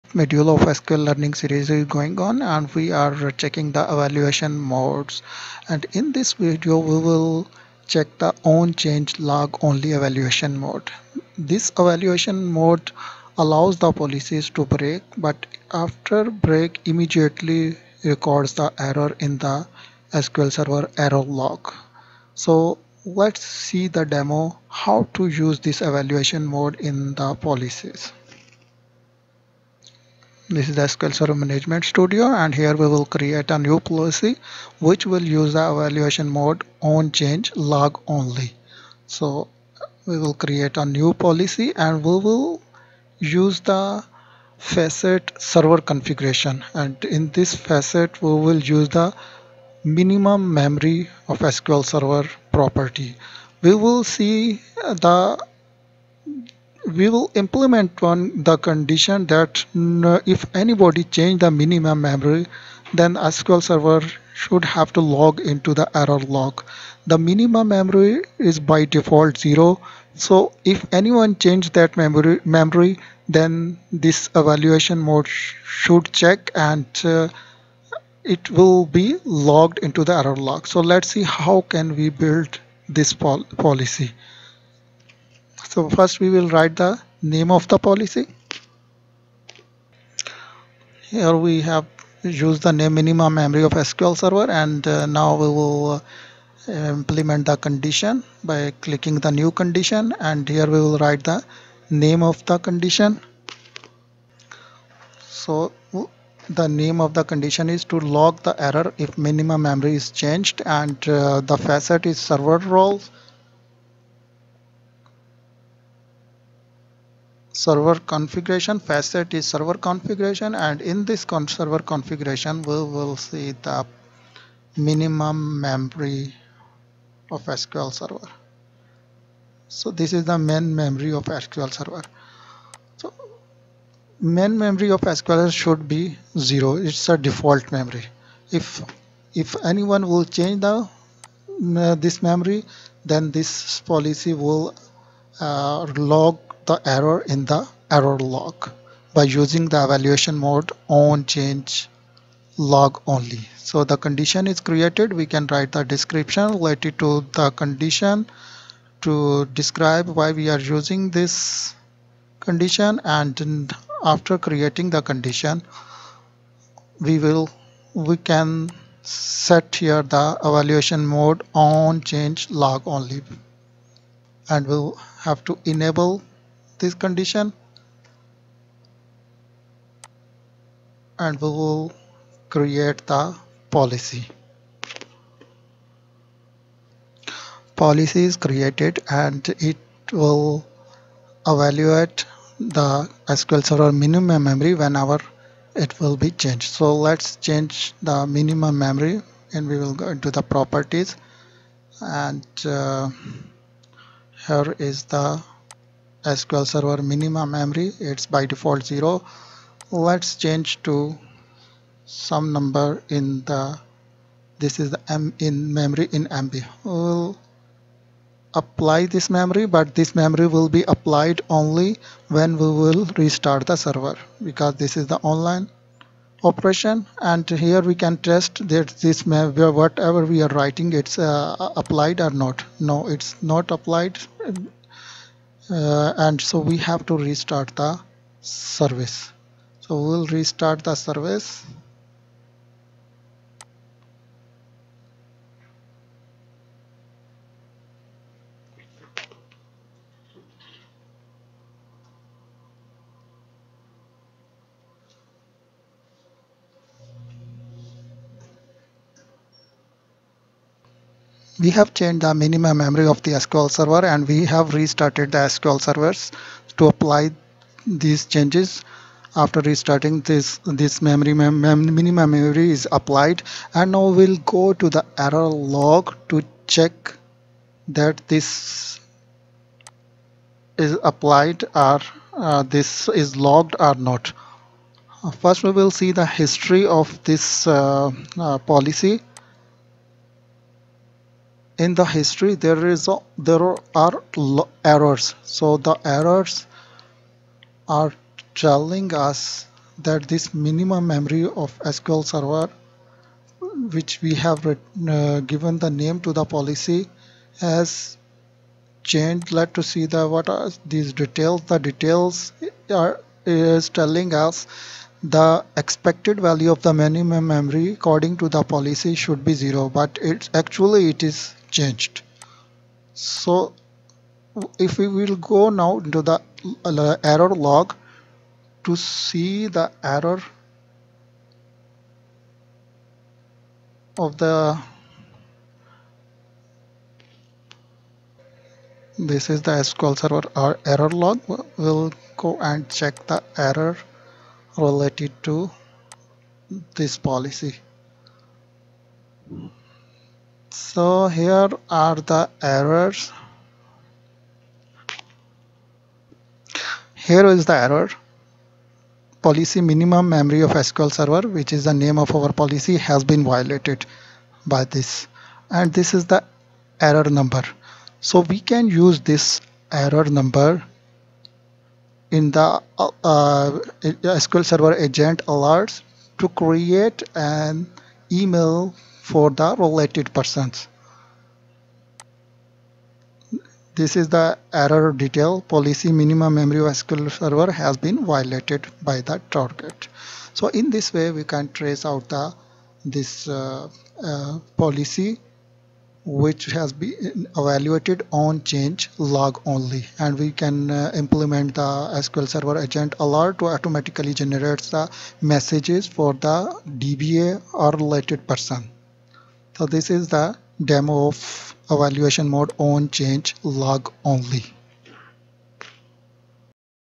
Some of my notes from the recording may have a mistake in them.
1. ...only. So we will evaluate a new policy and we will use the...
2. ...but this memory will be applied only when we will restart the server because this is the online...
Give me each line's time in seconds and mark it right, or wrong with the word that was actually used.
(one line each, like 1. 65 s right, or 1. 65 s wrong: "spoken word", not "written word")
1. 38 s wrong: "create", not "evaluate"
2. 219 s right.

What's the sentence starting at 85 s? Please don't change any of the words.
So first we will write the name of the policy.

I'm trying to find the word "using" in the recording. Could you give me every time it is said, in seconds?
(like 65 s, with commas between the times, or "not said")
149 s, 160 s.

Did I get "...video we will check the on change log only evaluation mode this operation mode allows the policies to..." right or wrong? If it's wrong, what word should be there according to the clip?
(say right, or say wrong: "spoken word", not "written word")
wrong: "evaluation", not "operation".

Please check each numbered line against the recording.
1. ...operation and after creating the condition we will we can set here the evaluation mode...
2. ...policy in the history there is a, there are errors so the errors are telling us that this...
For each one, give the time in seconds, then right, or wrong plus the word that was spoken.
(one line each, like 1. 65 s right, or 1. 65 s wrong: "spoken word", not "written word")
1. 162 s wrong: "condition", not "operation"
2. 288 s right.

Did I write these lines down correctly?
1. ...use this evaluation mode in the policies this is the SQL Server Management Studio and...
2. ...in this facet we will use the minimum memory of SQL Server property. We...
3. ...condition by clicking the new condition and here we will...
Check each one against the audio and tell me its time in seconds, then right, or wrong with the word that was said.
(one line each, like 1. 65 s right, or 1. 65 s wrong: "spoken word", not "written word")
1. 25 s right
2. 47 s right
3. 97 s right.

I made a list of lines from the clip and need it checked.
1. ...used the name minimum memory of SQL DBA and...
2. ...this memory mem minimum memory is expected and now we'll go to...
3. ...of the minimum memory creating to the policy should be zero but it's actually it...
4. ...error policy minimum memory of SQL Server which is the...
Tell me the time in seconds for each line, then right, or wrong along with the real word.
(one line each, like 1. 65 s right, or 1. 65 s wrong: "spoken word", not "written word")
1. 92 s wrong: "Server", not "DBA"
2. 270 s wrong: "applied", not "expected"
3. 316 s wrong: "according", not "creating"
4. 357 s right.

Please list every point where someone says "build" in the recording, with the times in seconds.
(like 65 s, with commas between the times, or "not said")
82 s.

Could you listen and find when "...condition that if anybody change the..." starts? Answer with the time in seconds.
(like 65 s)
58 s.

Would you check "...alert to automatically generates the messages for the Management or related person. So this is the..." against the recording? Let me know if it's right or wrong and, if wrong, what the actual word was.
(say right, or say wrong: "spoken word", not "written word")
wrong: "DBA", not "Management".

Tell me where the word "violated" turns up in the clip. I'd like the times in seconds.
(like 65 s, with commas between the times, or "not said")
363 s, 388 s.